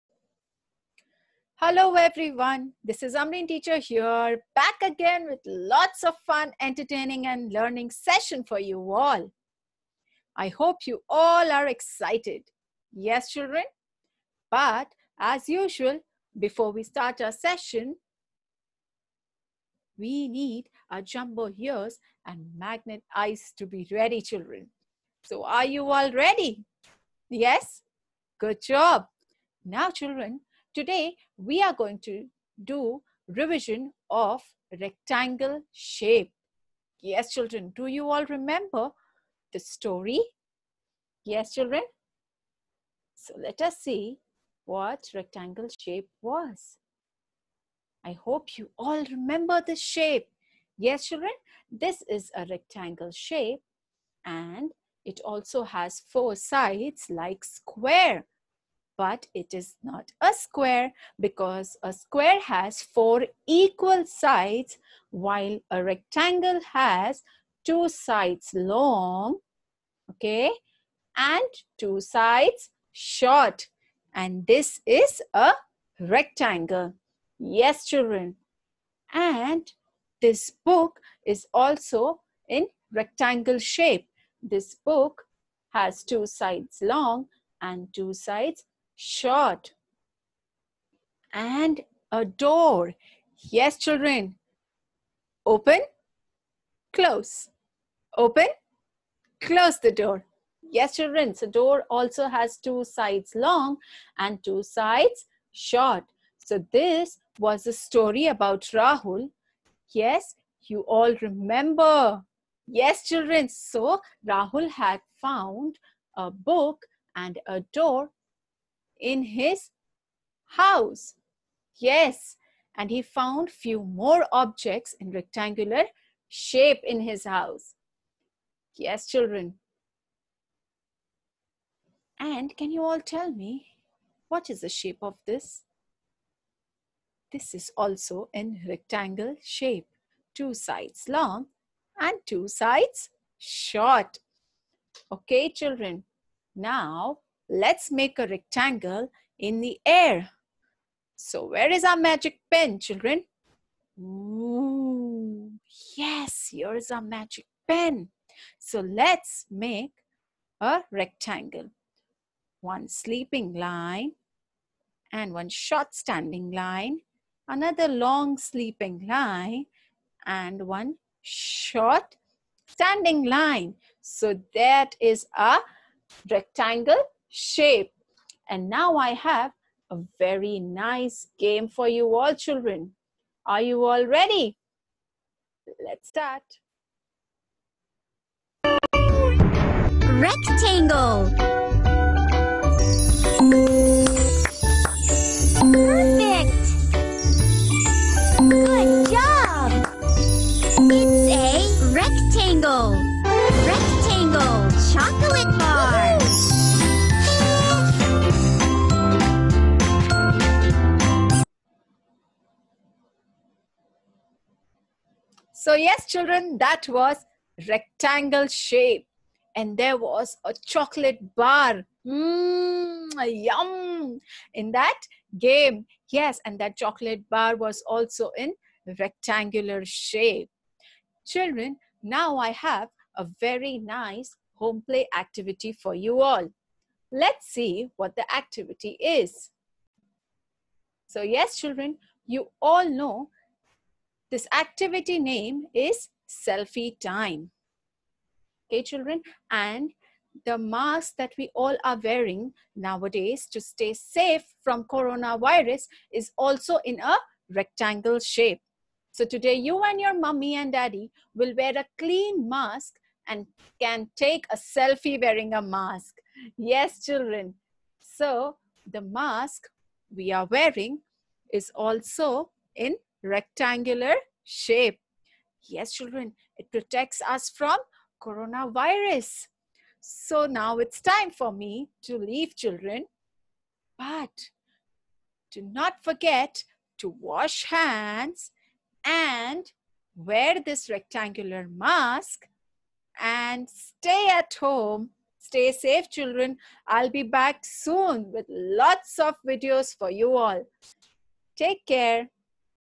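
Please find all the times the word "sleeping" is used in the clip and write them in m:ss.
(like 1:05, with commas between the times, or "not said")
2:42, 2:48.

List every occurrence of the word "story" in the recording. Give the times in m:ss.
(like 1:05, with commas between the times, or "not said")
0:39, 1:47.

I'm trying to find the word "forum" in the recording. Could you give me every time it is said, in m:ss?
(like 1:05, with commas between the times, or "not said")
not said.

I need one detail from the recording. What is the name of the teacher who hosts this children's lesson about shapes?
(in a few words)
Amreen.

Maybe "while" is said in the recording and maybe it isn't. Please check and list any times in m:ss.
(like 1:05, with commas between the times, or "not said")
1:05.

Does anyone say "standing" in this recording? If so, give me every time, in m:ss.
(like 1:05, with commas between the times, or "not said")
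2:45, 2:52.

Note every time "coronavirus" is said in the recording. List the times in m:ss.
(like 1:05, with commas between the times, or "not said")
4:14, 4:38.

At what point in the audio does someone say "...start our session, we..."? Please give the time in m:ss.
0:16.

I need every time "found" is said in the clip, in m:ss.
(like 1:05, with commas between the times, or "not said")
1:55, 2:03.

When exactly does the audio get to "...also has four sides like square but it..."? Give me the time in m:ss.
0:55.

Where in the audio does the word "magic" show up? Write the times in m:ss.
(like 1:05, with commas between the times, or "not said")
2:31, 2:37.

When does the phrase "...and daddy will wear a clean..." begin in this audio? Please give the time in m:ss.
4:20.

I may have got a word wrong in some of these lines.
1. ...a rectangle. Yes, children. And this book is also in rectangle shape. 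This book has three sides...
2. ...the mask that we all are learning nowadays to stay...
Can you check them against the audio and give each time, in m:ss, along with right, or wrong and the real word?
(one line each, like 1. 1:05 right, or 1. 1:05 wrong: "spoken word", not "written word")
1. 1:15 wrong: "two", not "three"
2. 4:10 wrong: "wearing", not "learning".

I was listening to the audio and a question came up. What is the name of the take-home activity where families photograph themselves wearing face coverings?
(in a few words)
selfie time.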